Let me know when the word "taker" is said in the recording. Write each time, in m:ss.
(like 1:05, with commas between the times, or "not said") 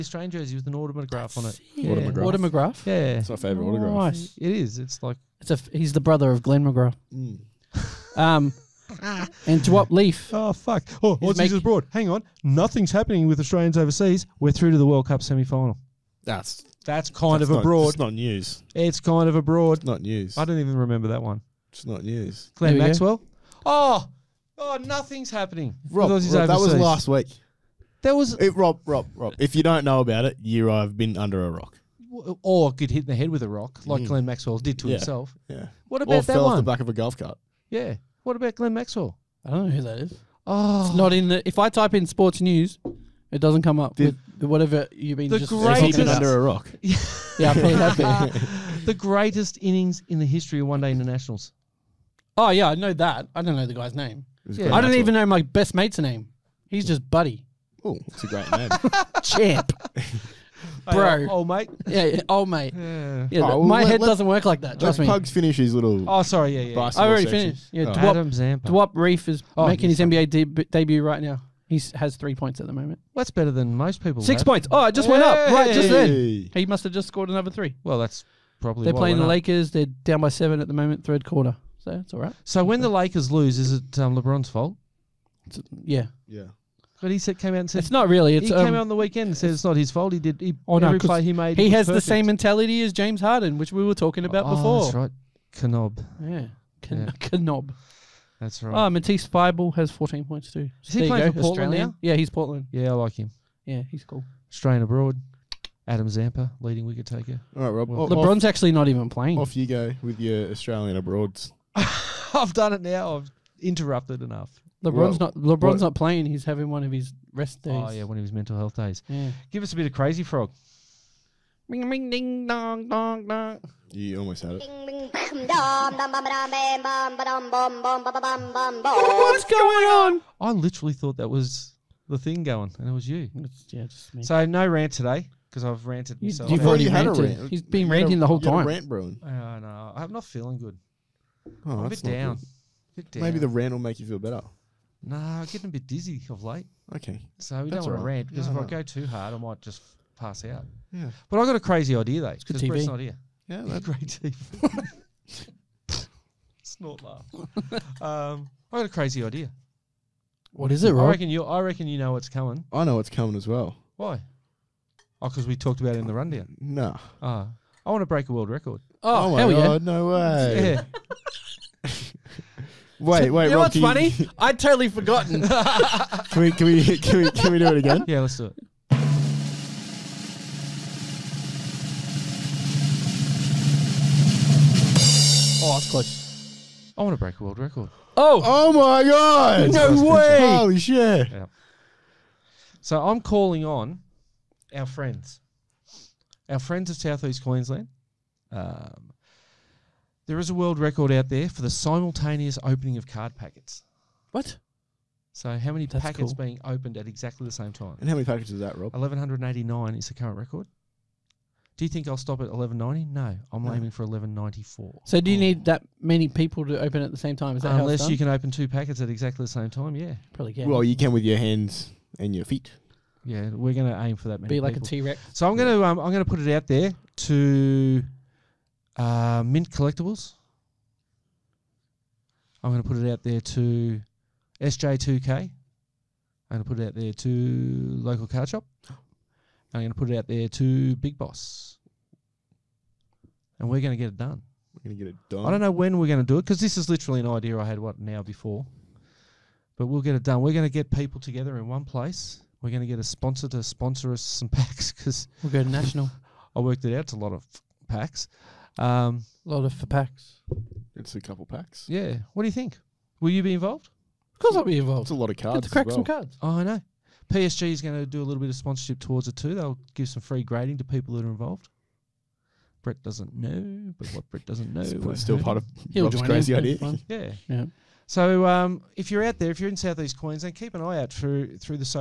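1:47.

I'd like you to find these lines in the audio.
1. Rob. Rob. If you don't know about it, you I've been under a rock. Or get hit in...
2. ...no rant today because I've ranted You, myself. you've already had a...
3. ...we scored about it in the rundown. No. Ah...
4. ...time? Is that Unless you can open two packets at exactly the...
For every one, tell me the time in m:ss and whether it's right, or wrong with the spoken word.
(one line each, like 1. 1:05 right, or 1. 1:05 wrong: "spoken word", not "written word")
1. 0:28 right
2. 2:14 right
3. 2:45 wrong: "talked", not "scored"
4. 3:37 right.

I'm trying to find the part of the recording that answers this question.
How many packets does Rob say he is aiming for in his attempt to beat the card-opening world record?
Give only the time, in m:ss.
3:34.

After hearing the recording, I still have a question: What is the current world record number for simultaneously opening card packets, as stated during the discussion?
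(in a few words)
1189.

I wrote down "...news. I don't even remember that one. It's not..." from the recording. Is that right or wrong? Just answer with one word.
right.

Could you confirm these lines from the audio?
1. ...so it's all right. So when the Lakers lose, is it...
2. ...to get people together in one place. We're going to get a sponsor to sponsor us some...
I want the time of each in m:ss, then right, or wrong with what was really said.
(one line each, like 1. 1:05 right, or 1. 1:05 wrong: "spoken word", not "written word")
1. 1:21 right
2. 4:10 right.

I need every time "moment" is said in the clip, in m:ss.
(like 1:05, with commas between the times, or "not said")
1:12, 1:20.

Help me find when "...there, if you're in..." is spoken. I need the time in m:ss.
4:39.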